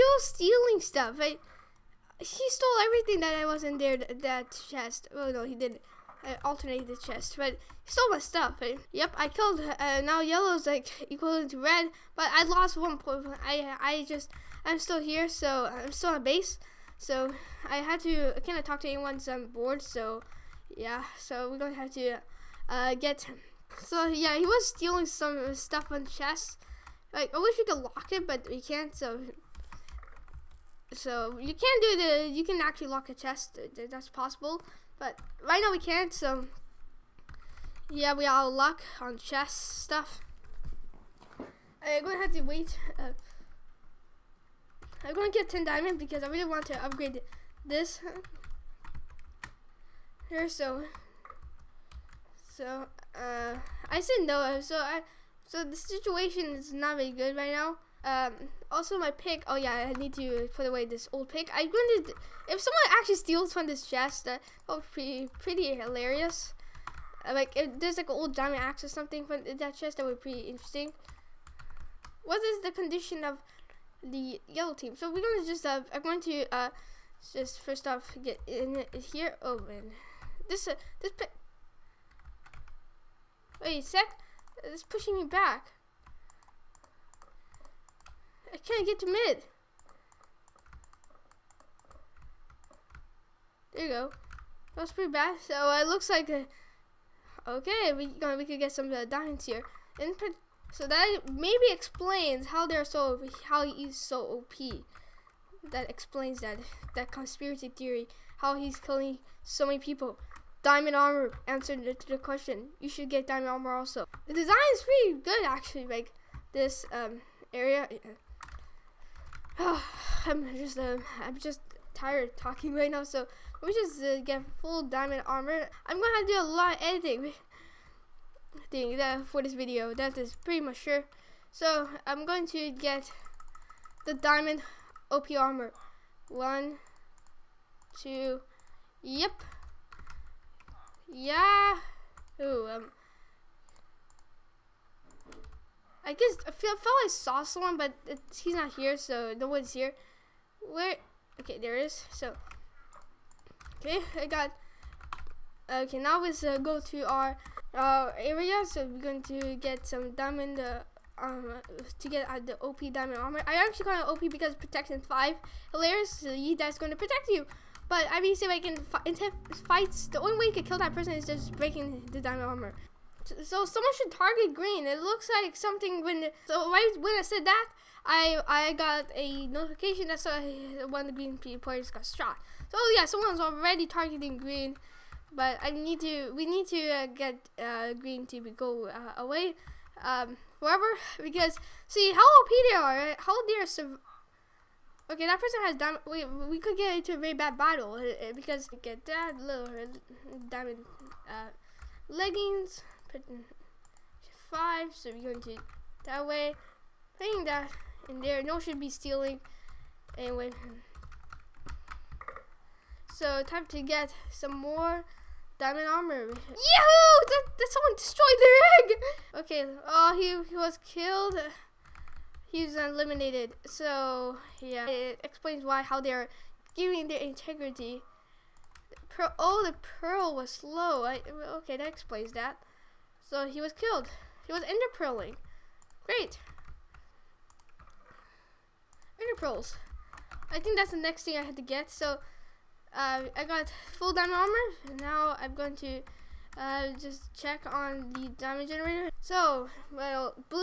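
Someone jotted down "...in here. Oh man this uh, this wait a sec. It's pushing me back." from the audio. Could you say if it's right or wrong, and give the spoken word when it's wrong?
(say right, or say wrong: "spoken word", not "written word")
right.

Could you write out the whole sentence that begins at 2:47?
But I mean, see if I can intense fights.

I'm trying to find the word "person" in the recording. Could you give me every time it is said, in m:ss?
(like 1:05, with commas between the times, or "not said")
2:50, 3:15.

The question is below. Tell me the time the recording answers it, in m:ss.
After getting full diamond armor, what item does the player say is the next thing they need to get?
3:59.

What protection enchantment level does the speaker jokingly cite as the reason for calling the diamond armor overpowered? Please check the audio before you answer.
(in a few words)
Protection 5.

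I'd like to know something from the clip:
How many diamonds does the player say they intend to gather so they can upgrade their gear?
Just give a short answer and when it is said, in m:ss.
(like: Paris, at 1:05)
10, at 0:45.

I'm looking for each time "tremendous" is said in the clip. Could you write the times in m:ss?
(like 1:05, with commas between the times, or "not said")
not said.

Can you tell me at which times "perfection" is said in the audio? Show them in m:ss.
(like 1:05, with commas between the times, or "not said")
not said.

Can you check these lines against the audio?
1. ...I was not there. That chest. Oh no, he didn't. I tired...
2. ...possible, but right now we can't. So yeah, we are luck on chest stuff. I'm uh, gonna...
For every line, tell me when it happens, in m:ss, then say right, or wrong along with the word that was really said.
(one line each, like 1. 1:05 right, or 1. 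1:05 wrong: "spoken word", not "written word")
1. 0:03 wrong: "alternated", not "tired"
2. 0:34 right.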